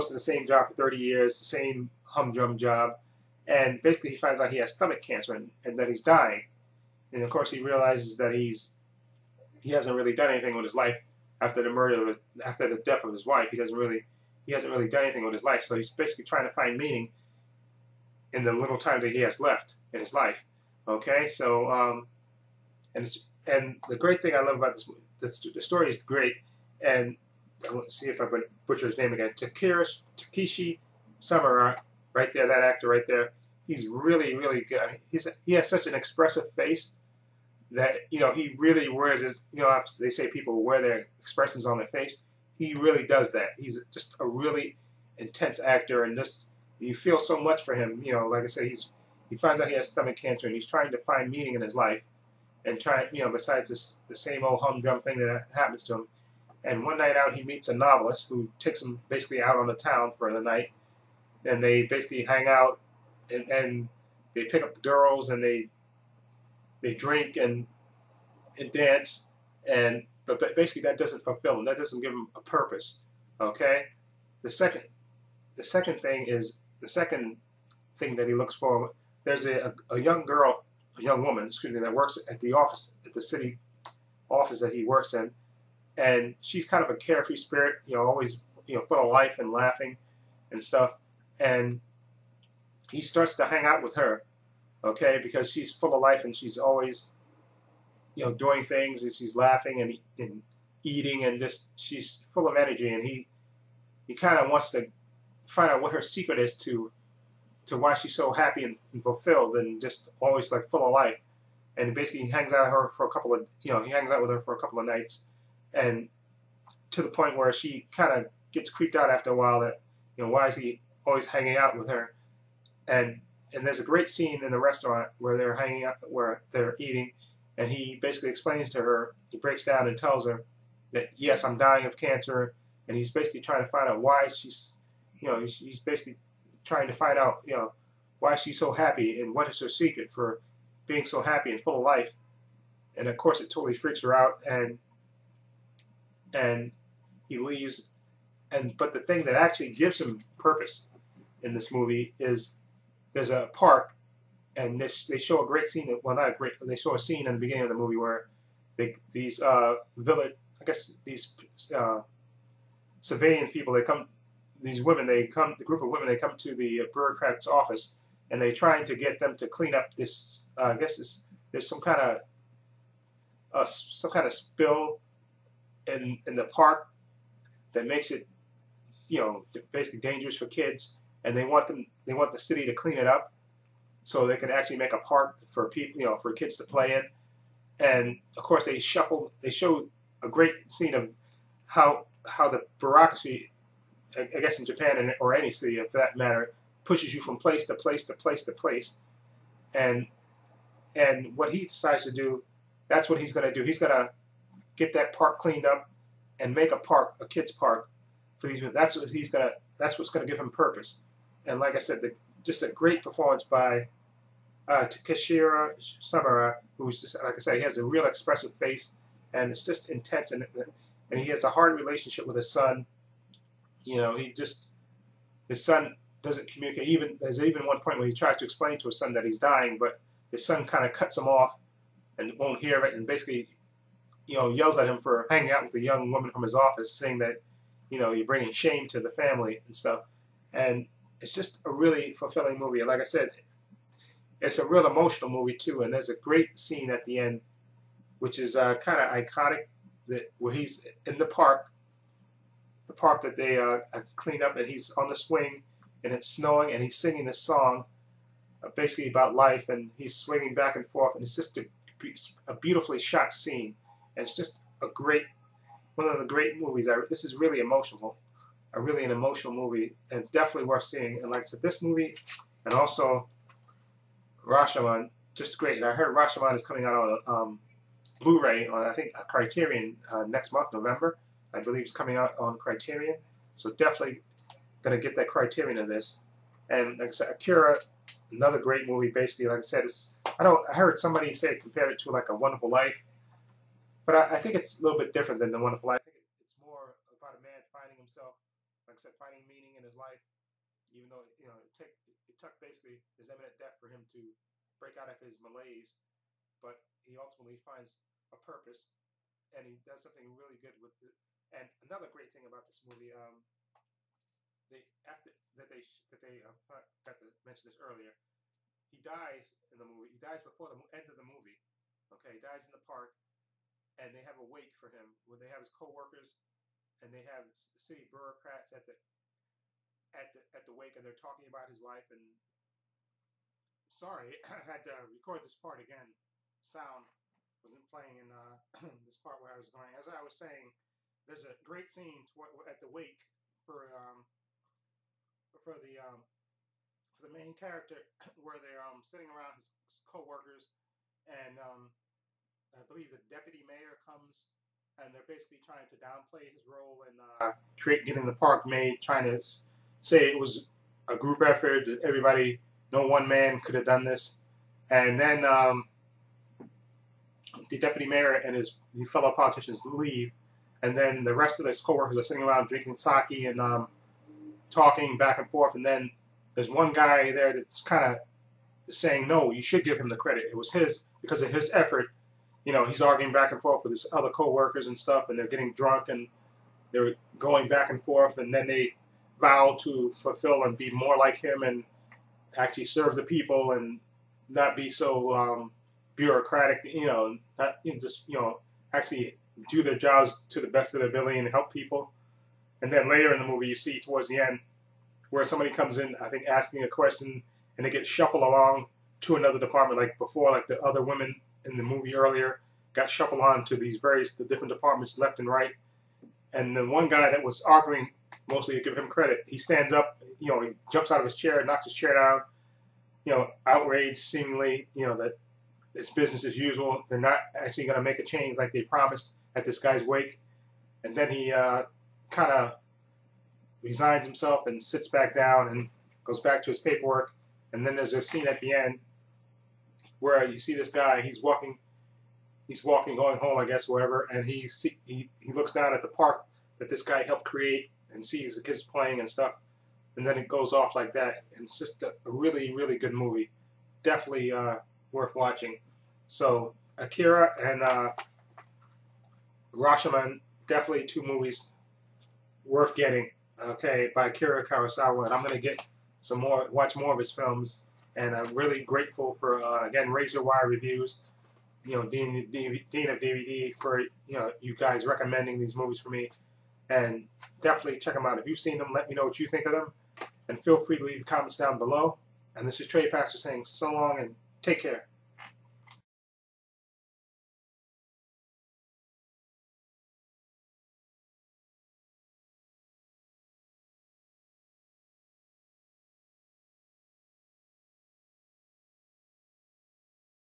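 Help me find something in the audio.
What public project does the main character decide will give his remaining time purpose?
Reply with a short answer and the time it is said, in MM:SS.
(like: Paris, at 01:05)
A kids park, at 03:27.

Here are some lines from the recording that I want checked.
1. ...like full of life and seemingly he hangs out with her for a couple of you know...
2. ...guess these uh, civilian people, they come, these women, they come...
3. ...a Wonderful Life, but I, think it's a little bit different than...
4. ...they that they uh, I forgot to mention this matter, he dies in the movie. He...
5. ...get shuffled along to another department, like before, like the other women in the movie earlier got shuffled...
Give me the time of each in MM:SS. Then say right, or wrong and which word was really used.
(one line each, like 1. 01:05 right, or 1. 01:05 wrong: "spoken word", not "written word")
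1. 01:50 wrong: "basically", not "seemingly"
2. 02:40 right
3. 04:52 right
4. 05:15 wrong: "earlier", not "matter"
5. 06:47 right.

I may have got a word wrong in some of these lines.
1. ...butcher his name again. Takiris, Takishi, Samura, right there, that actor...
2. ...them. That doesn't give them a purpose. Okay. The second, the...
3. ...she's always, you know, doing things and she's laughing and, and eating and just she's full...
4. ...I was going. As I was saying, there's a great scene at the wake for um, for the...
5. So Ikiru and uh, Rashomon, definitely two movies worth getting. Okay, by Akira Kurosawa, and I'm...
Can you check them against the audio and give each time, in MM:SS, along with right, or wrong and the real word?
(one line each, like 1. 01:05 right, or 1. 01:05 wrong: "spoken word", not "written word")
1. 00:28 right
2. 01:11 right
3. 01:36 right
4. 05:39 right
5. 07:36 right.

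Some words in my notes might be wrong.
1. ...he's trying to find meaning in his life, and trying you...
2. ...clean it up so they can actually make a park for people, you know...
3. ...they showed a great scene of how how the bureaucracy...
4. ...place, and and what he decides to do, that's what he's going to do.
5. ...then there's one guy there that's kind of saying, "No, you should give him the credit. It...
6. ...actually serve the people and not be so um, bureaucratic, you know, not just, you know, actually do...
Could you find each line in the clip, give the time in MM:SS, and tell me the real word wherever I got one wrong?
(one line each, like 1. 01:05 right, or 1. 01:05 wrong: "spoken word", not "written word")
1. 00:50 right
2. 03:02 right
3. 03:09 right
4. 03:18 right
5. 06:15 right
6. 06:32 right.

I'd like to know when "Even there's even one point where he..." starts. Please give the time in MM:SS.
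03:46.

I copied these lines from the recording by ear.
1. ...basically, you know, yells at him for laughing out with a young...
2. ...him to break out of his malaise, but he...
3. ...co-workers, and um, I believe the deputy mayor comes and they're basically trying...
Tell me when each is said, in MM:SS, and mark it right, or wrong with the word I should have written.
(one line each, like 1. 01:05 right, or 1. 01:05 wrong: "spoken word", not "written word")
1. 03:53 wrong: "hanging", not "laughing"
2. 05:03 right
3. 05:50 right.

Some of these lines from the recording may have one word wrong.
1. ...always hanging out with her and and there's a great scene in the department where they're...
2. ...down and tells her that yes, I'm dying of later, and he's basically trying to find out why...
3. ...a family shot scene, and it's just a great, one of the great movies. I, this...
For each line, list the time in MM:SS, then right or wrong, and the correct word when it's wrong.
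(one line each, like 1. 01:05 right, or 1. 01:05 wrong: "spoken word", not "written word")
1. 02:01 wrong: "restaurant", not "department"
2. 02:09 wrong: "cancer", not "later"
3. 04:22 wrong: "beautifully", not "family".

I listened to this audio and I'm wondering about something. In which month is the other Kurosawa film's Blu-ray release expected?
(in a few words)
November.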